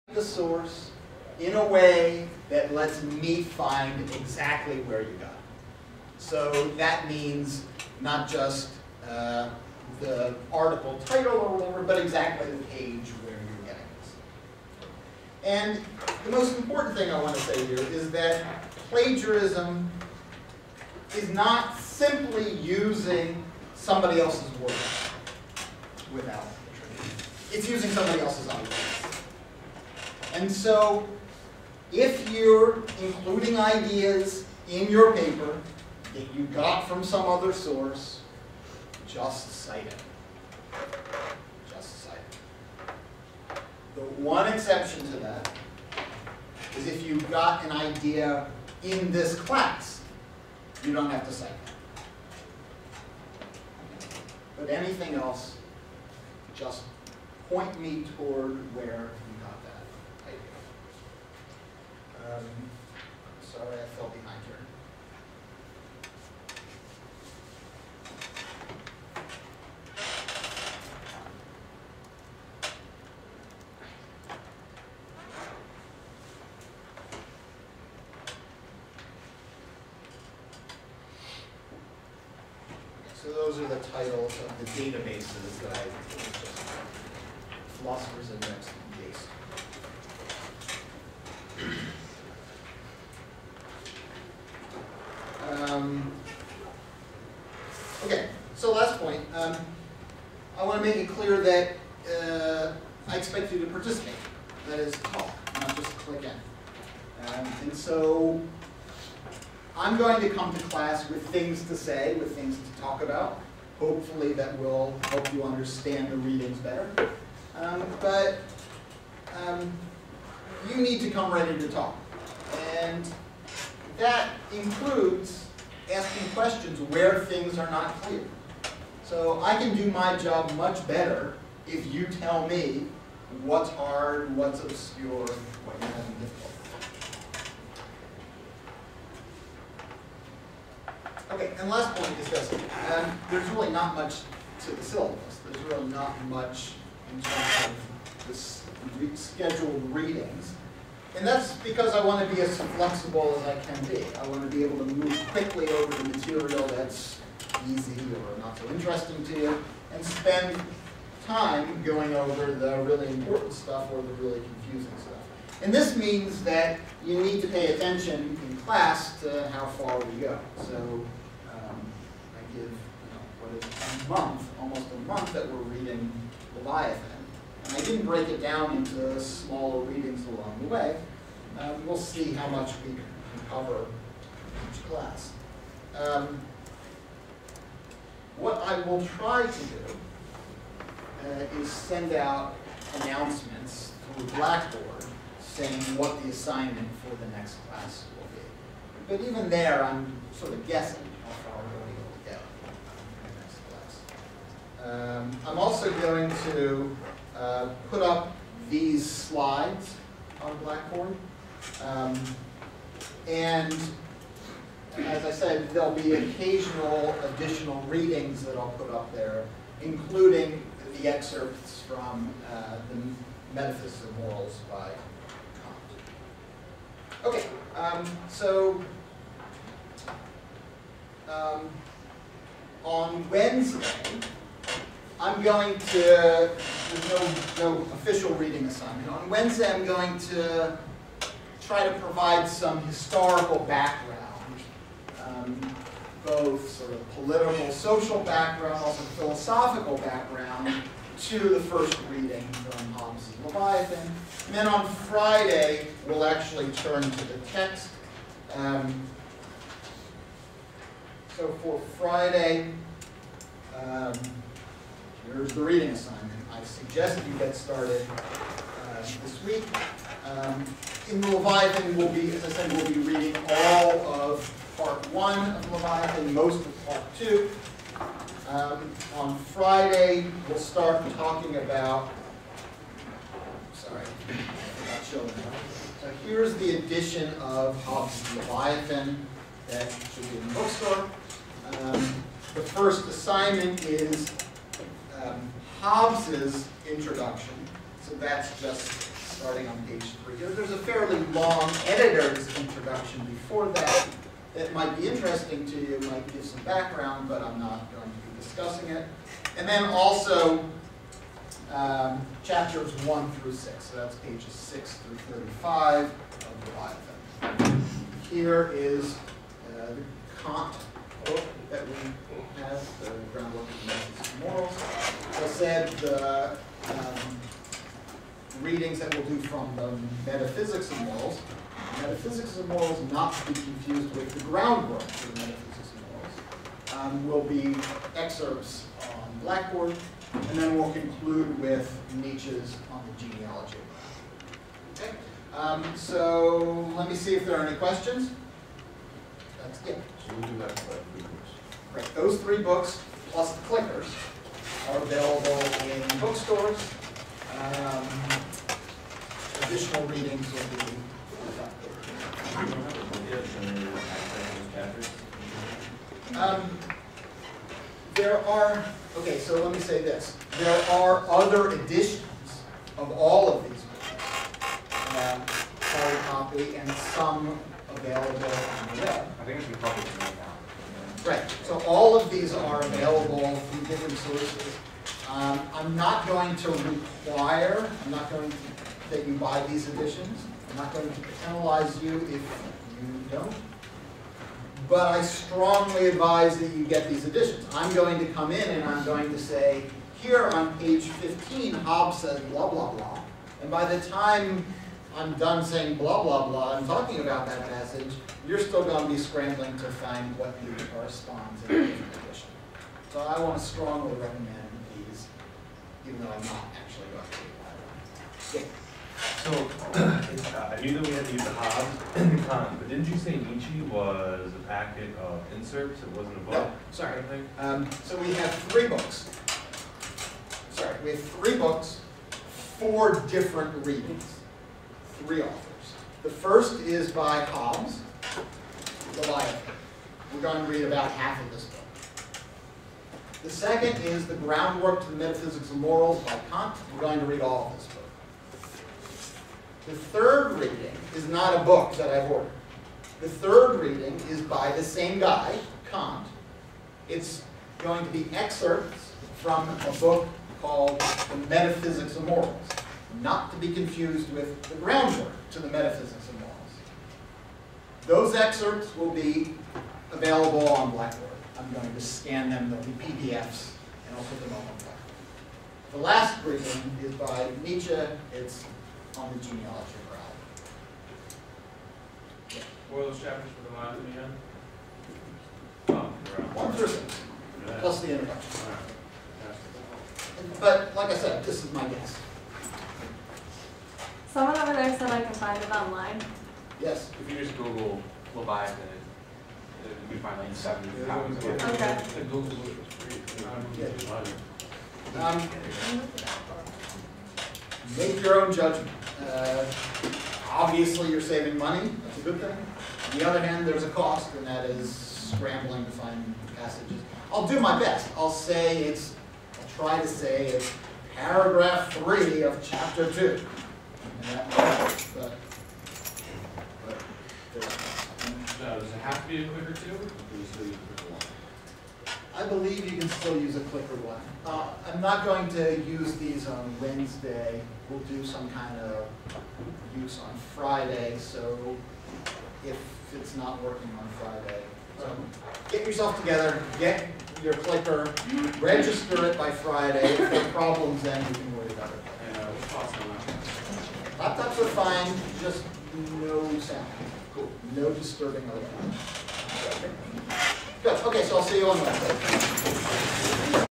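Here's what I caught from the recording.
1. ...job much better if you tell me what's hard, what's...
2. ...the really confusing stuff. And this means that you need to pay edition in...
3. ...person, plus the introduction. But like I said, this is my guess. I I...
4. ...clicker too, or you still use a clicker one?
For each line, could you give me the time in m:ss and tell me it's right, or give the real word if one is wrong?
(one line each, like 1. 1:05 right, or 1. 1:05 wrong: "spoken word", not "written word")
1. 2:10 right
2. 2:44 wrong: "attention", not "edition"
3. 8:06 right
4. 8:49 right.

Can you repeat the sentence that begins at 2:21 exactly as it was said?
and last point is this, there's really not much to the syllabus.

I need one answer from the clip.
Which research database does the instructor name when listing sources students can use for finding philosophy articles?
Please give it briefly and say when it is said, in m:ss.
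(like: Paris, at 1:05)
Philosophers Index, at 1:27.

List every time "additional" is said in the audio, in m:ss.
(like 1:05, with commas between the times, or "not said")
3:37, 5:59.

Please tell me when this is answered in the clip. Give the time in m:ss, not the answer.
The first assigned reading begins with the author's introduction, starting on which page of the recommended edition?
4:59.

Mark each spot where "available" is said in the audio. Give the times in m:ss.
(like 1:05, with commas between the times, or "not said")
5:54, 6:17, 6:22, 7:50.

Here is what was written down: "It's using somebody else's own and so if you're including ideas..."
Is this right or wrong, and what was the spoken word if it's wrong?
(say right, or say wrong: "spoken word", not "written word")
right.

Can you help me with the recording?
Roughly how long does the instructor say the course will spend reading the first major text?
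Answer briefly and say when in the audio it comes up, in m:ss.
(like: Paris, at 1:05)
almost a month, at 2:54.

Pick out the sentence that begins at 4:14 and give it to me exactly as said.
And then on Friday, we'll actually turn to the text.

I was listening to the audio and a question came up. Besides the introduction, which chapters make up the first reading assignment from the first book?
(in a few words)
chapters 1 through 6.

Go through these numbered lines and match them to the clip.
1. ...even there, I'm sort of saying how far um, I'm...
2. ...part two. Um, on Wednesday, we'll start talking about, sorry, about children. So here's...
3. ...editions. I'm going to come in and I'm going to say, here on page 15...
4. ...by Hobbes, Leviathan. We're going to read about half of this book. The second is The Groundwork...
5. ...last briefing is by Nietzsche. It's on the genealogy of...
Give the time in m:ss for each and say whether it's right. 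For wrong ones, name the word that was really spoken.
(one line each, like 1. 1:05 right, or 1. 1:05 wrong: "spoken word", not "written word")
1. 3:19 wrong: "guessing", not "saying"
2. 4:36 wrong: "Friday", not "Wednesday"
3. 6:37 right
4. 7:17 right
5. 7:55 right.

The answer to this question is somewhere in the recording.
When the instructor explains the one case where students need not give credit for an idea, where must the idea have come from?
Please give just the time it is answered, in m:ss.
0:49.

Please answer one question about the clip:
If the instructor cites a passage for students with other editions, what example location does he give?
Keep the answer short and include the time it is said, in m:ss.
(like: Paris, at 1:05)
paragraph 3 of chapter 2, at 8:41.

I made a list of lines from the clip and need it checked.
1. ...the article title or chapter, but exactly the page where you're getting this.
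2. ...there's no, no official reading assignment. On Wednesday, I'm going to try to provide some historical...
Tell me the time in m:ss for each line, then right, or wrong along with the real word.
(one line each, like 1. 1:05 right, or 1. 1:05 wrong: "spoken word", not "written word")
1. 0:09 wrong: "whatever", not "chapter"
2. 3:55 right.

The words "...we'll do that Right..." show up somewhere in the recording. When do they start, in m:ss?
5:50.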